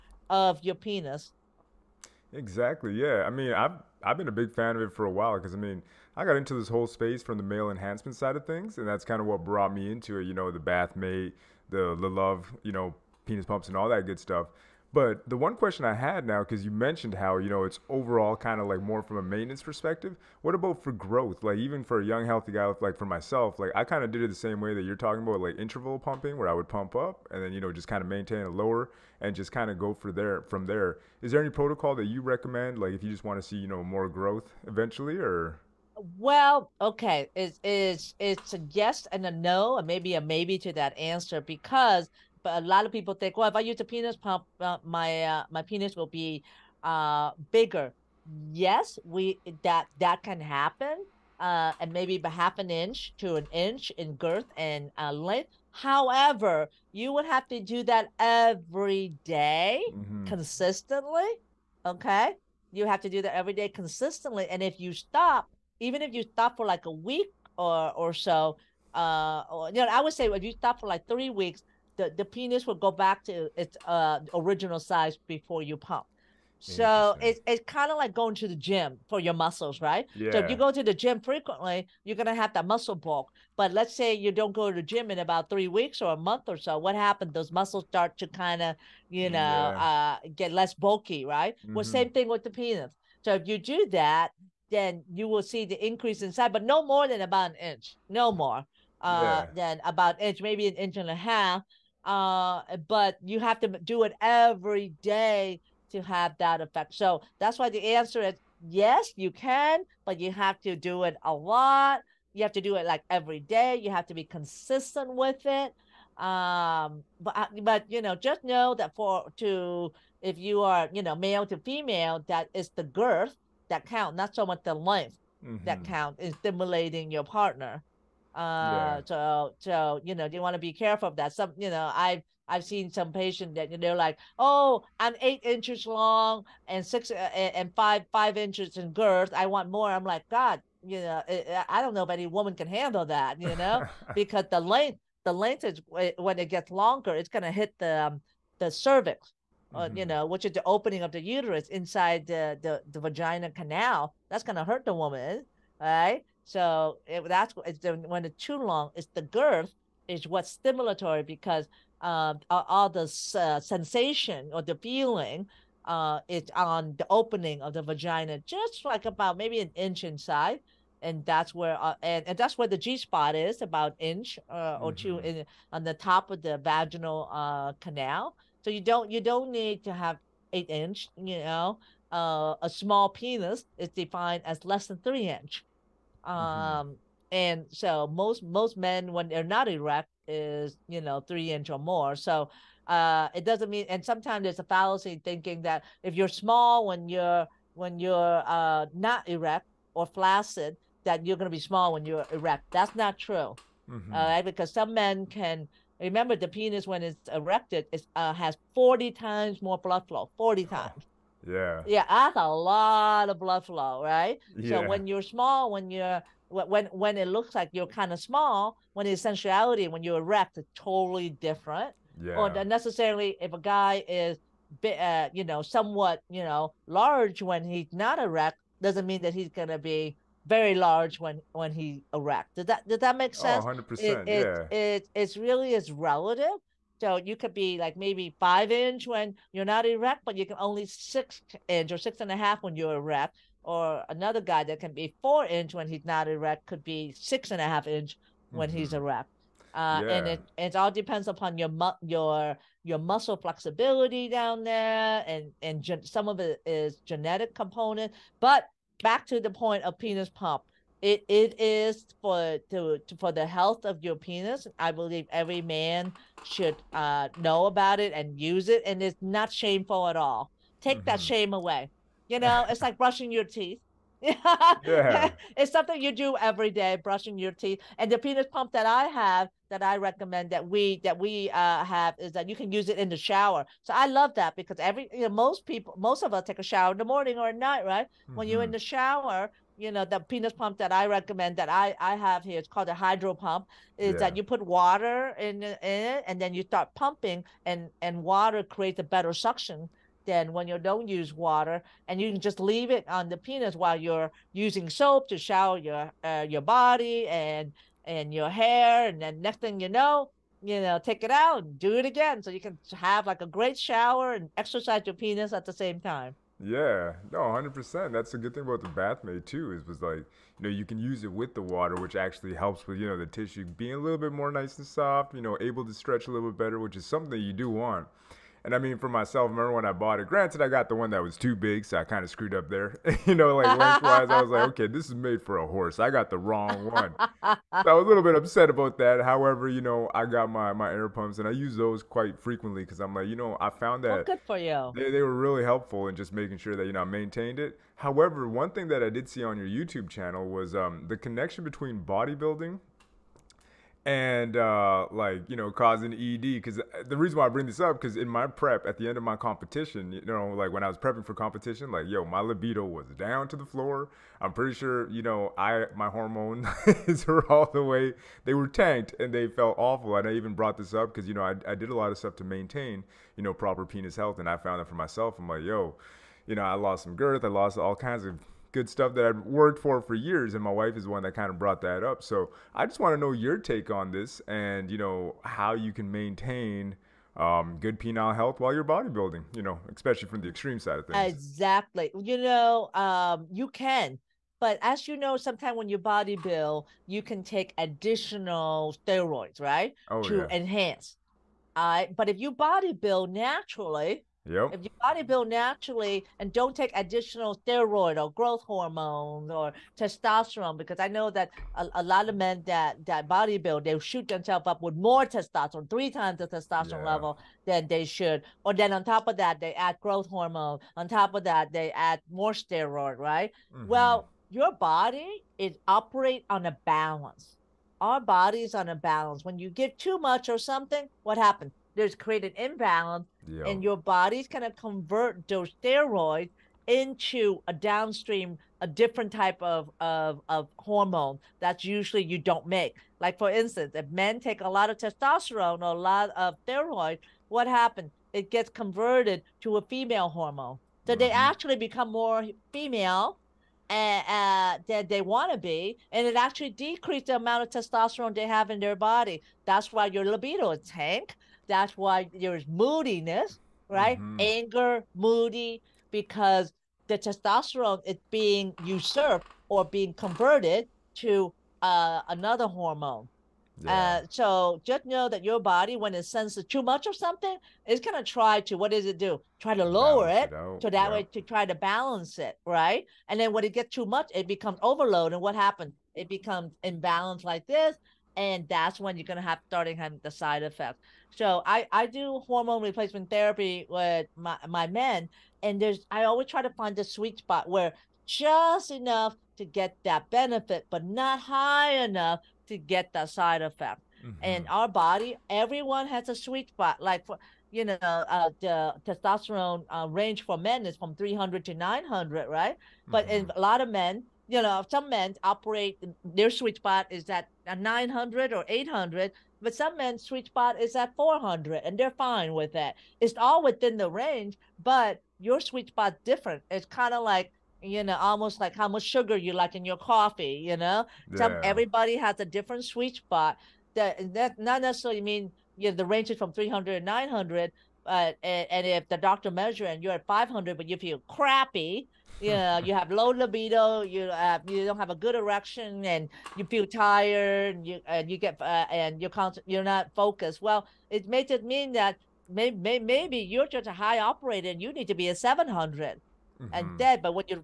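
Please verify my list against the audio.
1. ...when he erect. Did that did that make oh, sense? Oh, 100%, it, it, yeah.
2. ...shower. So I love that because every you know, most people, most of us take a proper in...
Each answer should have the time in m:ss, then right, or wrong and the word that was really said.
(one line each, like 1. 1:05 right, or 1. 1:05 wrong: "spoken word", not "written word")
1. 3:51 right
2. 4:43 wrong: "shower", not "proper".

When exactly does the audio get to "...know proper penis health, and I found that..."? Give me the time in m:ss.
6:13.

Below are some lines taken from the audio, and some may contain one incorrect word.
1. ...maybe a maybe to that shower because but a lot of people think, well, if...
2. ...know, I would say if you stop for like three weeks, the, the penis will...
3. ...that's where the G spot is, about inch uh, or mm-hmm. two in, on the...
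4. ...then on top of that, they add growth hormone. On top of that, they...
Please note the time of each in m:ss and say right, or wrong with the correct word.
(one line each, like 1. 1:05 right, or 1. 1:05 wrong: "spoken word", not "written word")
1. 0:39 wrong: "answer", not "shower"
2. 1:09 right
3. 2:52 right
4. 6:58 right.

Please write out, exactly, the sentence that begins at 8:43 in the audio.
It's all within the range, but your sweet spot's different.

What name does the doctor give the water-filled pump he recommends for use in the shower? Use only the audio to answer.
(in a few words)
hydro pump.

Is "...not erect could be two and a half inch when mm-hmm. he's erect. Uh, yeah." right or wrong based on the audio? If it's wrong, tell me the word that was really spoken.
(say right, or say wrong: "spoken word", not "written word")
wrong: "six", not "two".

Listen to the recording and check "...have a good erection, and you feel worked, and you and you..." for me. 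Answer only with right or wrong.
wrong.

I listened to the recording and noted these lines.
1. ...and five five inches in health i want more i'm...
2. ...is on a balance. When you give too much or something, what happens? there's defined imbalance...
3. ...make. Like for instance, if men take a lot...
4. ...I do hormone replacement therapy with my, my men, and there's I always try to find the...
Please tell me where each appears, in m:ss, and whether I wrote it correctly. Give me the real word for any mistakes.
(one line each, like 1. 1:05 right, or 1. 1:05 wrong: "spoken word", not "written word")
1. 2:17 wrong: "girth", not "health"
2. 7:08 wrong: "created", not "defined"
3. 7:22 right
4. 8:11 right.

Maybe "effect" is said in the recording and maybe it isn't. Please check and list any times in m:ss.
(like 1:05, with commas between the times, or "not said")
1:46, 8:10, 8:23.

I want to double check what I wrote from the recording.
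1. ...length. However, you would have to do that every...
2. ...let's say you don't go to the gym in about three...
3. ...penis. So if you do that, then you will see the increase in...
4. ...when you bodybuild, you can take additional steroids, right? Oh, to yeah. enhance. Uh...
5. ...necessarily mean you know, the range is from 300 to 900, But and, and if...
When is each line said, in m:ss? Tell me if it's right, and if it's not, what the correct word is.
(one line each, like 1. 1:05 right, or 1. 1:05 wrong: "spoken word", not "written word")
1. 0:55 right
2. 1:23 right
3. 1:32 right
4. 6:35 right
5. 8:54 right.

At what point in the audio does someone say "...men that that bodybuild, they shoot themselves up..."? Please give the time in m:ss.
6:52.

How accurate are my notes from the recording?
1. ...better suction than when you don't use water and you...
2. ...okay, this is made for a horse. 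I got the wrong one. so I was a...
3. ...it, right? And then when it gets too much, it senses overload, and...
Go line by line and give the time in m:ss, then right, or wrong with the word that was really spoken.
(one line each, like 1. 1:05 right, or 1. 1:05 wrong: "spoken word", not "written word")
1. 4:59 right
2. 5:34 right
3. 8:02 wrong: "becomes", not "senses".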